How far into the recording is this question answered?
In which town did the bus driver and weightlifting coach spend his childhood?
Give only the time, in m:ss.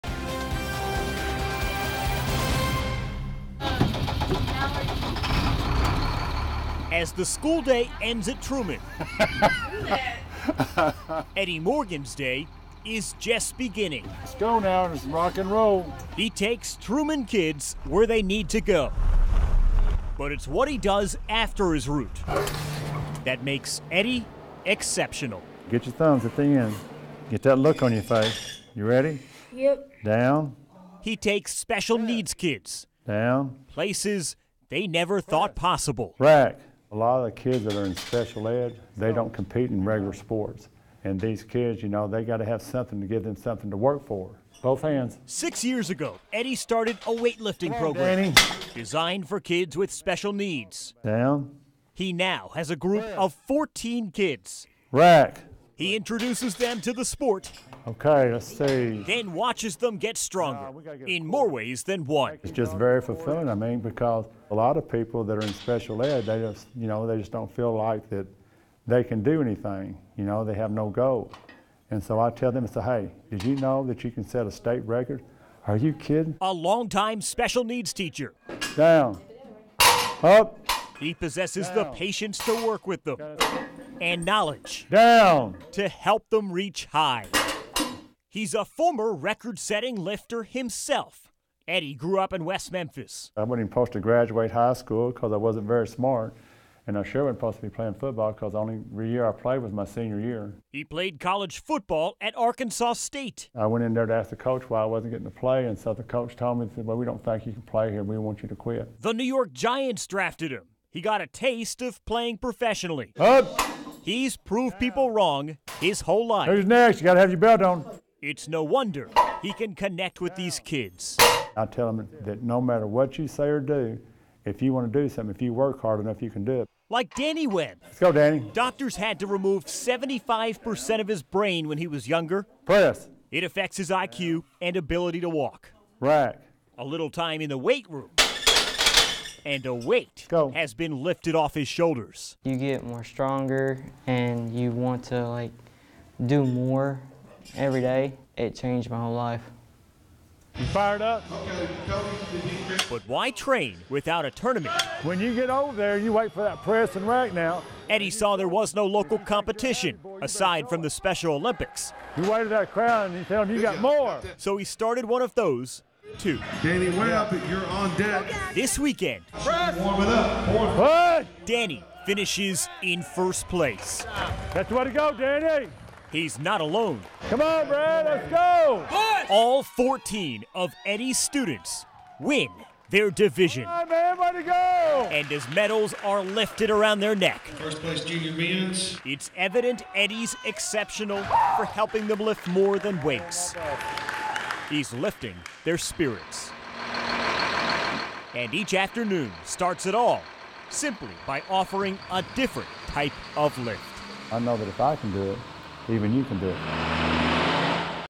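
1:32.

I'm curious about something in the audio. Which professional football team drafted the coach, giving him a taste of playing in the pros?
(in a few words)
New York Giants.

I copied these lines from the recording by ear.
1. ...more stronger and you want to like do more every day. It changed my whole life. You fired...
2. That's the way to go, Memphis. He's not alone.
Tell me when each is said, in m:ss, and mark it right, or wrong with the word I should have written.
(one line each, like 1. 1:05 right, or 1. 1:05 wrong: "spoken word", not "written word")
1. 2:22 right
2. 2:54 wrong: "Danny", not "Memphis".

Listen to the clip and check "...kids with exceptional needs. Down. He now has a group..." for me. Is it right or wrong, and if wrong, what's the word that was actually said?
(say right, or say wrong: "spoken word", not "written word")
wrong: "special", not "exceptional".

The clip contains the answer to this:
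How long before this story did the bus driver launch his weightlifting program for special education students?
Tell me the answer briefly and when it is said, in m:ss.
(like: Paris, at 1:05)
6 years, at 0:45.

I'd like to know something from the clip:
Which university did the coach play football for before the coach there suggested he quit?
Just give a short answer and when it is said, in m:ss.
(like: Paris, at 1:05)
Arkansas State, at 1:42.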